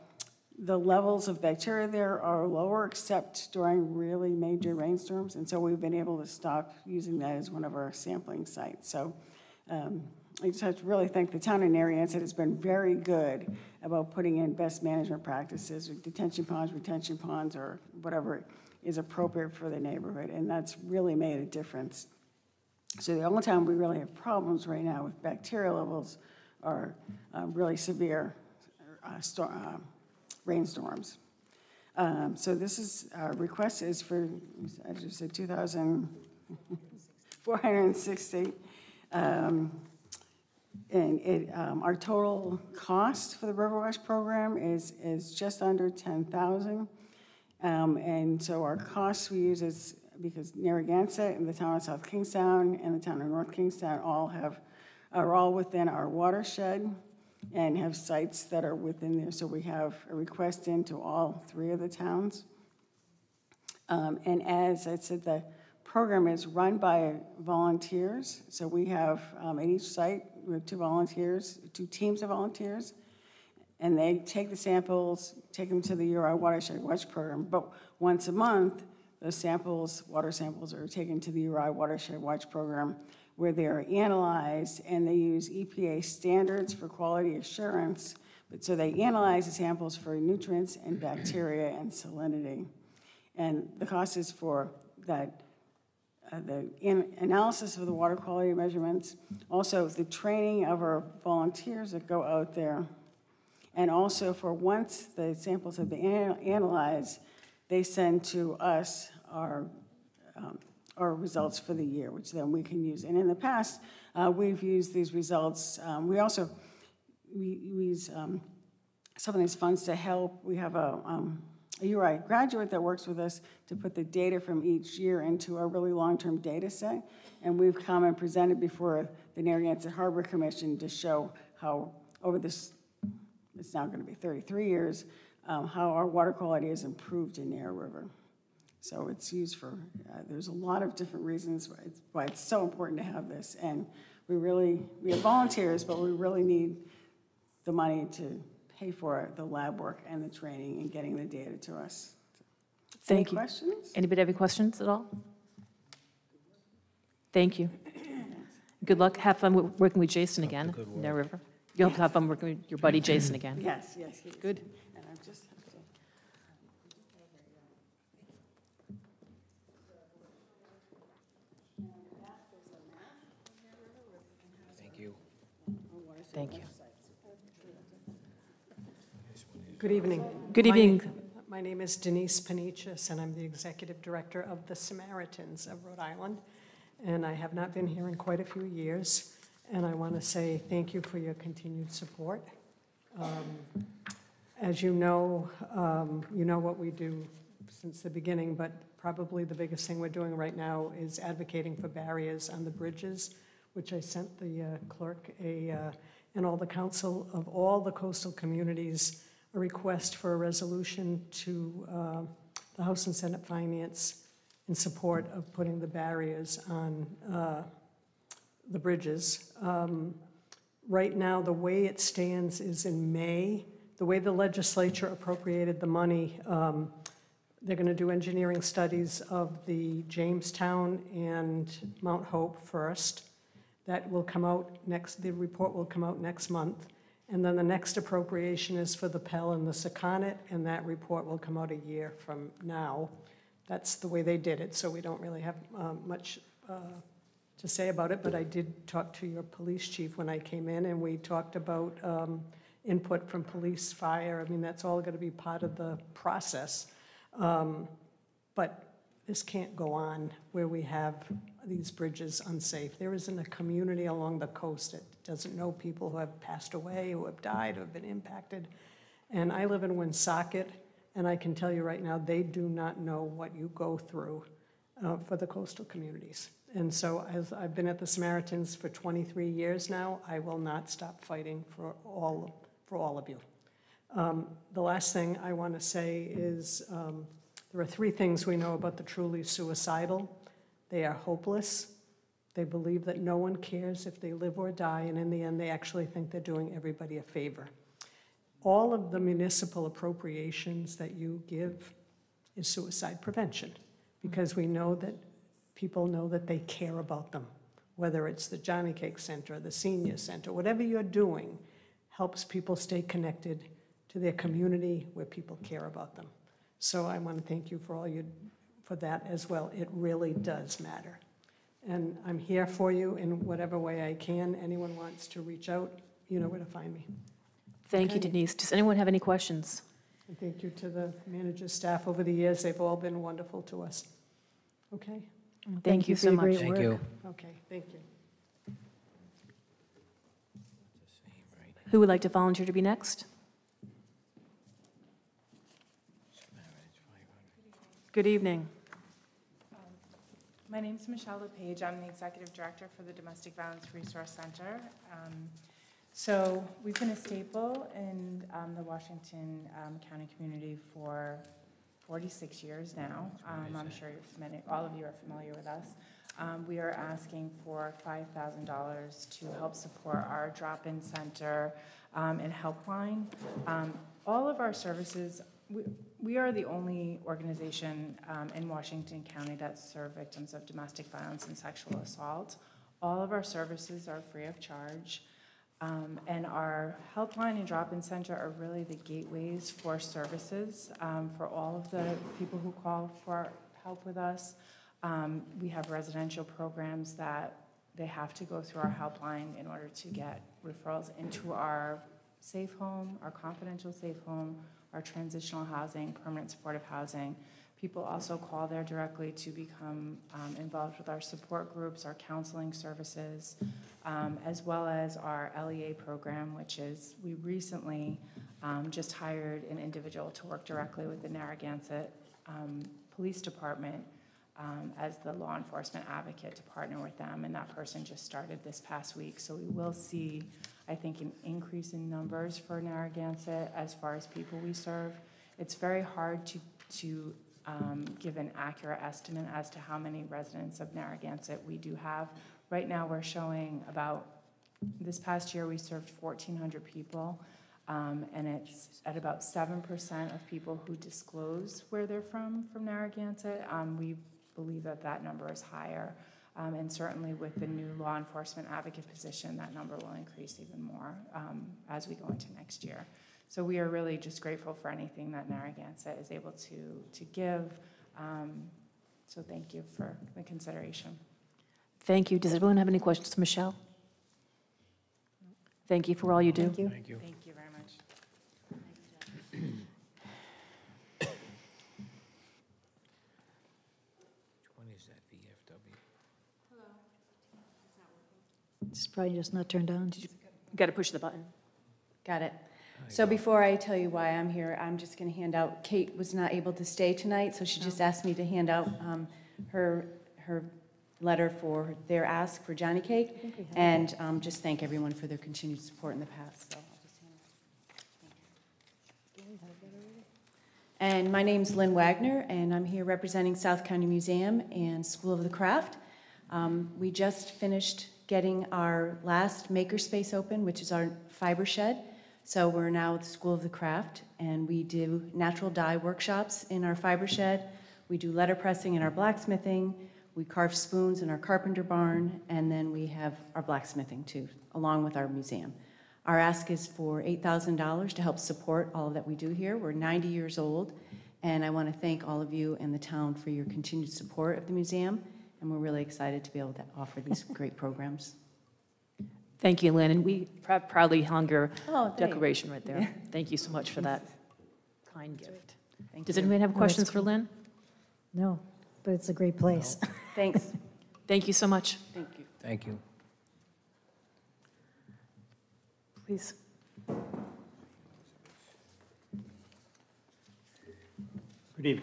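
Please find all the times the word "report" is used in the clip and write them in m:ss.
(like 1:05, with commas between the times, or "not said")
3:55, 4:00.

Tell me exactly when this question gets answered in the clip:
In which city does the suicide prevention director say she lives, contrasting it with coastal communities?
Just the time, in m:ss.
4:29.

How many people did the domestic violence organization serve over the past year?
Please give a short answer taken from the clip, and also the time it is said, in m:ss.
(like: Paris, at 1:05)
1,400, at 7:26.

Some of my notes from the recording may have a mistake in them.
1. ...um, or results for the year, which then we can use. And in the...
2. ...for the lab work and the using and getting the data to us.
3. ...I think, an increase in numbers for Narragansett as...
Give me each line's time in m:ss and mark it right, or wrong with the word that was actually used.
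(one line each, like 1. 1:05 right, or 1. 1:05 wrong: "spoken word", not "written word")
1. 1:50 right
2. 2:28 wrong: "training", not "using"
3. 7:10 right.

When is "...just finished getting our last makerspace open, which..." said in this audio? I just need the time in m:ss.
8:37.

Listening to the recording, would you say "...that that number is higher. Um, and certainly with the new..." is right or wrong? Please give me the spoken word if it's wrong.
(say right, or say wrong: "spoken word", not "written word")
right.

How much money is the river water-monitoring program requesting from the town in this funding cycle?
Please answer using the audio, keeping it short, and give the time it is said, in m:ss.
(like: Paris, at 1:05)
$2,460, at 0:35.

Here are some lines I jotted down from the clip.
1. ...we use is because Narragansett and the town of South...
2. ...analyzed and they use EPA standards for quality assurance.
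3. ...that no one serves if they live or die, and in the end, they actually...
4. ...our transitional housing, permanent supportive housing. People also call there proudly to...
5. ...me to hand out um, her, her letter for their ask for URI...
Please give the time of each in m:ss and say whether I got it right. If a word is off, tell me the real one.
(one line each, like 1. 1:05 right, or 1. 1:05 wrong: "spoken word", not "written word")
1. 0:49 right
2. 1:23 right
3. 4:53 wrong: "cares", not "serves"
4. 6:44 wrong: "directly", not "proudly"
5. 8:18 wrong: "Jonnycake", not "URI".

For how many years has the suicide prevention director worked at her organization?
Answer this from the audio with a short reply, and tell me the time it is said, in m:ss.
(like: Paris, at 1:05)
23, at 4:38.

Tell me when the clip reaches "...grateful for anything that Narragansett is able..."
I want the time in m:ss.
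7:44.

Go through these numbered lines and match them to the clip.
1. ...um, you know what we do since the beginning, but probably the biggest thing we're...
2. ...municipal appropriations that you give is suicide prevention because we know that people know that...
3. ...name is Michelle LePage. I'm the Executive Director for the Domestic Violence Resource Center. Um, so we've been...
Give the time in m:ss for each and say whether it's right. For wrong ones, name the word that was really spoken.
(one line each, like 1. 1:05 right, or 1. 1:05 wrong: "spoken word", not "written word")
1. 3:15 right
2. 4:59 right
3. 5:50 right.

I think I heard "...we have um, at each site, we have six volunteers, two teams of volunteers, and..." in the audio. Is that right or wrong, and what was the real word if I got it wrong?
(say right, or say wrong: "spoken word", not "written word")
wrong: "two", not "six".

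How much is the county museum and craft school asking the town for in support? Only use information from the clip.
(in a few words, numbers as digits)
$8,000.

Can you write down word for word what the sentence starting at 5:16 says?
So I want to thank you for all you for that as well.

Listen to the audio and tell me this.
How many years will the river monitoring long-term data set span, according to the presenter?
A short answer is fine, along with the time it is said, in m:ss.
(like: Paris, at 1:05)
33, at 2:14.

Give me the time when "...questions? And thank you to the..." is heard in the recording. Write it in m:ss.
5:29.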